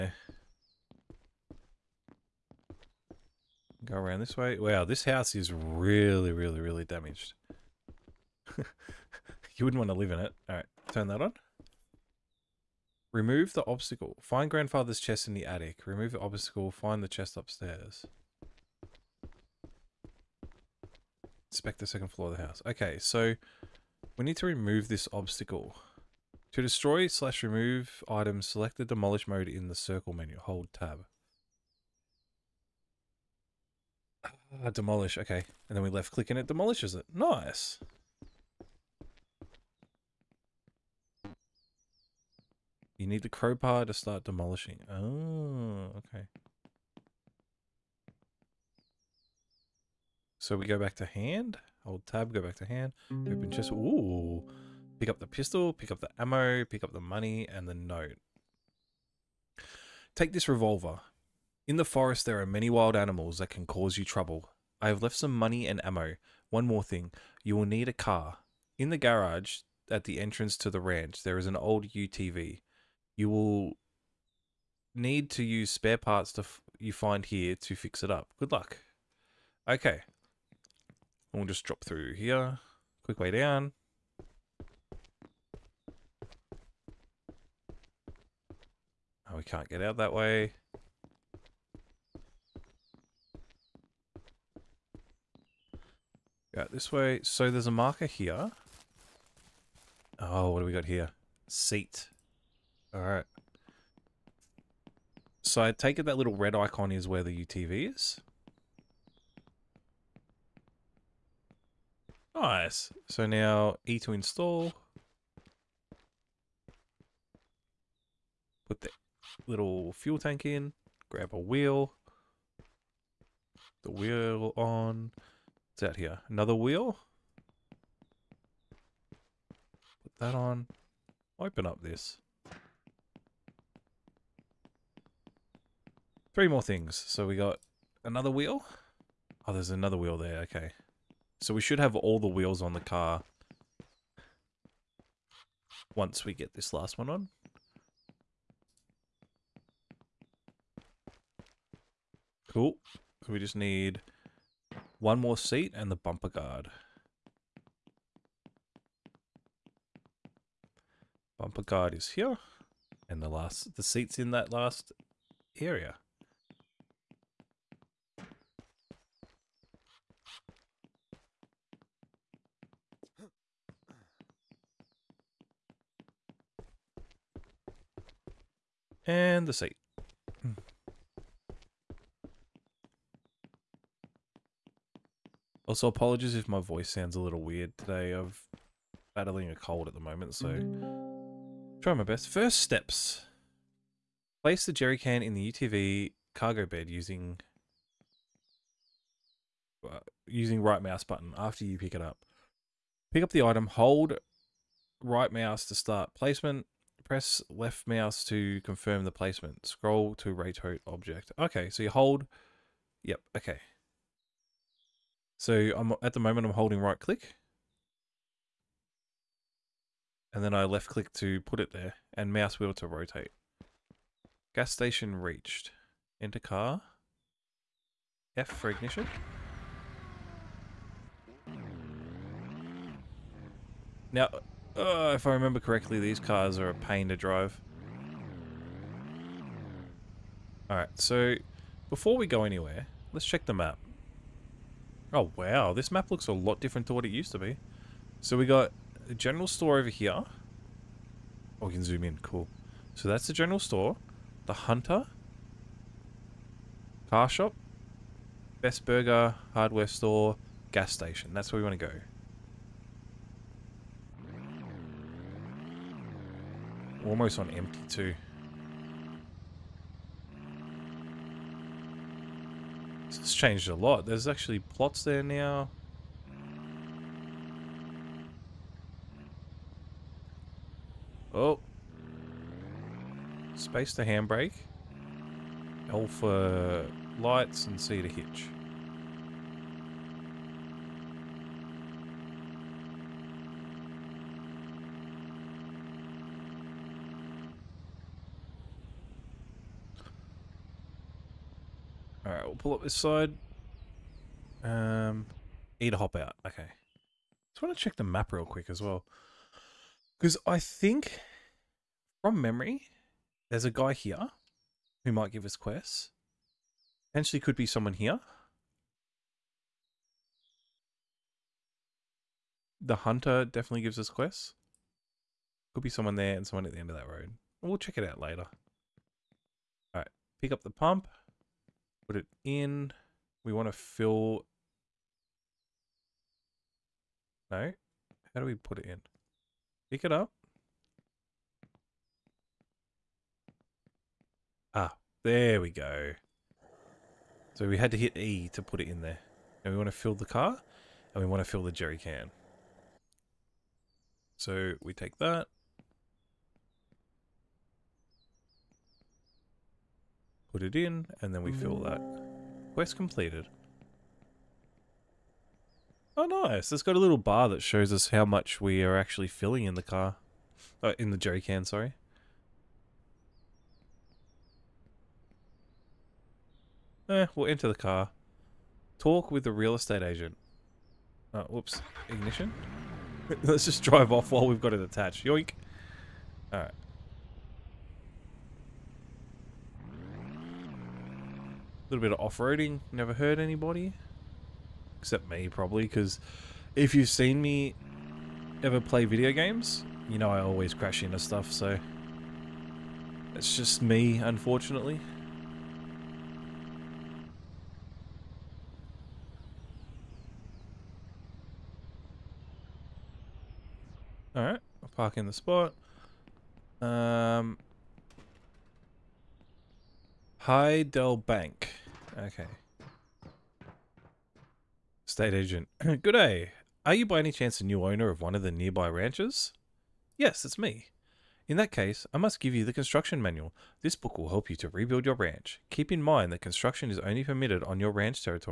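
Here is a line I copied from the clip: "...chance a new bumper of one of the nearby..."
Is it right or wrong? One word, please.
wrong.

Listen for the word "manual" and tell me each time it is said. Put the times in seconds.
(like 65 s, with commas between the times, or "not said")
433 s.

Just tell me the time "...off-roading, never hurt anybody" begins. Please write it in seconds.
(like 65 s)
392 s.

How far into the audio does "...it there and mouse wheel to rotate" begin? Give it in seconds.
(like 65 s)
221 s.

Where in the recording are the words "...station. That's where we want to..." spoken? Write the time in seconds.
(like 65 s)
260 s.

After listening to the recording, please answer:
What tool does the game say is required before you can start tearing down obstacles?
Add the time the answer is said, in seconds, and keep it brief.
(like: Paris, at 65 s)
crowbar, at 43 s.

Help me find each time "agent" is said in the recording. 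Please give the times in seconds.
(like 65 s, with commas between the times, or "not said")
380 s, 425 s.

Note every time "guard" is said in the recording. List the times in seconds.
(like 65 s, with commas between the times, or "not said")
156 s, 161 s.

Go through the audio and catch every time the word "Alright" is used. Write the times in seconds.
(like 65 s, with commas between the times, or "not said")
10 s, 102 s, 240 s, 302 s, 329 s, 386 s, 414 s.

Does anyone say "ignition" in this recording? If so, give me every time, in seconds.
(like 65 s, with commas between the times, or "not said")
228 s, 382 s.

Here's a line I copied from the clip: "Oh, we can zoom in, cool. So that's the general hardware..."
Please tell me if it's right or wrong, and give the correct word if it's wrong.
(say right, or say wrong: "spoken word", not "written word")
wrong: "store", not "hardware".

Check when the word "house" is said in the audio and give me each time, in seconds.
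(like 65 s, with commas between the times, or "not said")
5 s, 22 s.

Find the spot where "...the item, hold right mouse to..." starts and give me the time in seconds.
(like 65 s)
203 s.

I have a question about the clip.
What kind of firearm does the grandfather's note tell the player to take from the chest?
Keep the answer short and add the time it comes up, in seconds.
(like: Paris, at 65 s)
revolver, at 60 s.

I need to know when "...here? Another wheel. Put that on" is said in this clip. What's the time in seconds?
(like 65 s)
125 s.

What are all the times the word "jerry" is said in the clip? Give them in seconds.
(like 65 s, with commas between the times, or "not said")
194 s, 351 s, 371 s.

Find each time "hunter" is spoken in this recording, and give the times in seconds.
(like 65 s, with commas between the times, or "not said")
254 s, 322 s.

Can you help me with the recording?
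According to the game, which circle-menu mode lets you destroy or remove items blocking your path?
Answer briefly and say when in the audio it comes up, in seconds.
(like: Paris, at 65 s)
demolish mode, at 28 s.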